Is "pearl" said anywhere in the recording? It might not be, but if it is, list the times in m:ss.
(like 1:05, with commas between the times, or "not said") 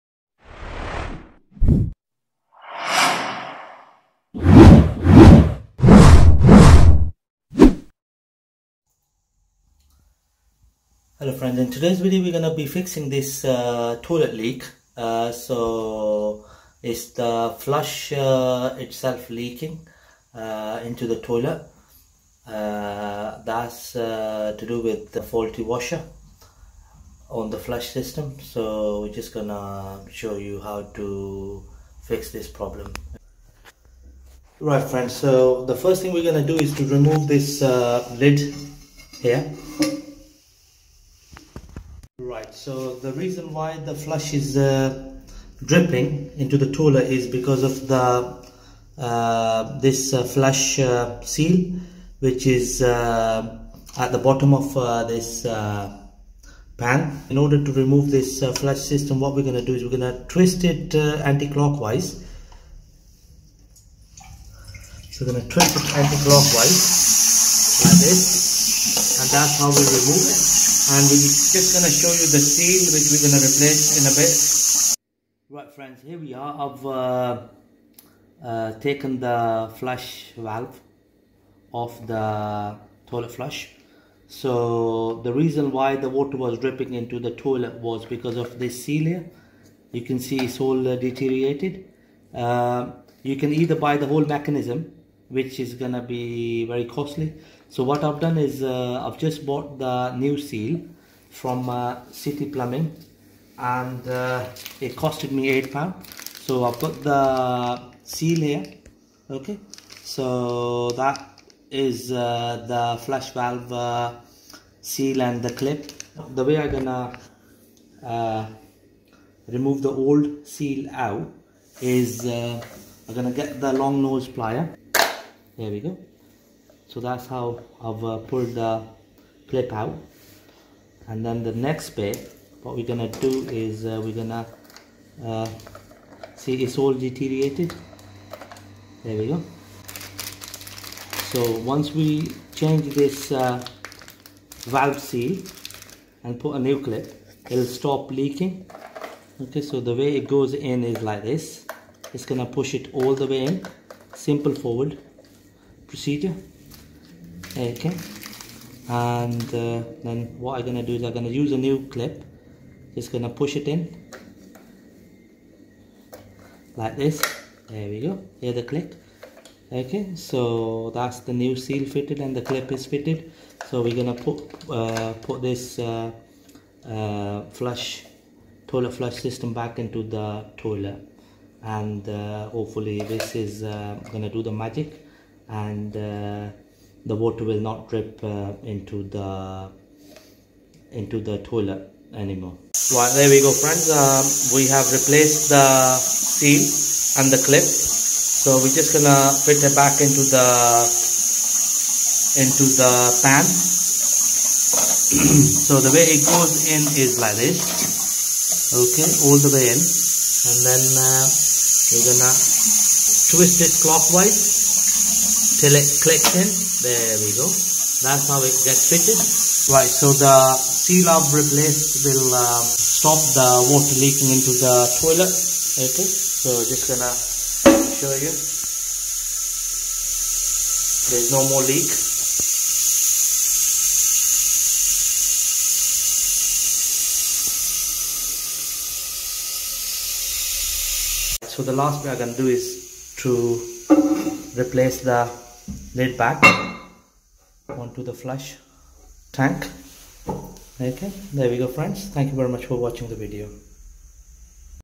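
not said.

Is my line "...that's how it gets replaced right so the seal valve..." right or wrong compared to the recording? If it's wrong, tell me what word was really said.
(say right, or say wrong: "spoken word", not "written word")
wrong: "fitted", not "replaced".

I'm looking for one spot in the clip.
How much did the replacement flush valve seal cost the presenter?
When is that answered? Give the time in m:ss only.
1:45.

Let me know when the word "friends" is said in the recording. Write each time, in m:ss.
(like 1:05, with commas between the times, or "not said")
0:11, 0:34, 1:15, 3:13, 4:11.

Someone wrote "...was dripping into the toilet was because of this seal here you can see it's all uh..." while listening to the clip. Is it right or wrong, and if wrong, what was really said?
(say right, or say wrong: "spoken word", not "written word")
right.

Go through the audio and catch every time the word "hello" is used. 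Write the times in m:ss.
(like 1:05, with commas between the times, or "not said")
0:11.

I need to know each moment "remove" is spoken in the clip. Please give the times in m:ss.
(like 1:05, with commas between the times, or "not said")
0:36, 0:57, 1:09, 1:59.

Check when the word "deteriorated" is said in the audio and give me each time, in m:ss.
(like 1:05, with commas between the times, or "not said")
1:30, 2:16.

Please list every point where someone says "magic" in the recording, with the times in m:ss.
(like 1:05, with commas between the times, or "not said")
3:04.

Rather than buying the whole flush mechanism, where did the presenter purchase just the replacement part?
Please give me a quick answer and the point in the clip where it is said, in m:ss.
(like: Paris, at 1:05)
City Plumbing, at 1:42.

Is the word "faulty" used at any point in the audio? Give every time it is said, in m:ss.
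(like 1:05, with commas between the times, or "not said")
0:25.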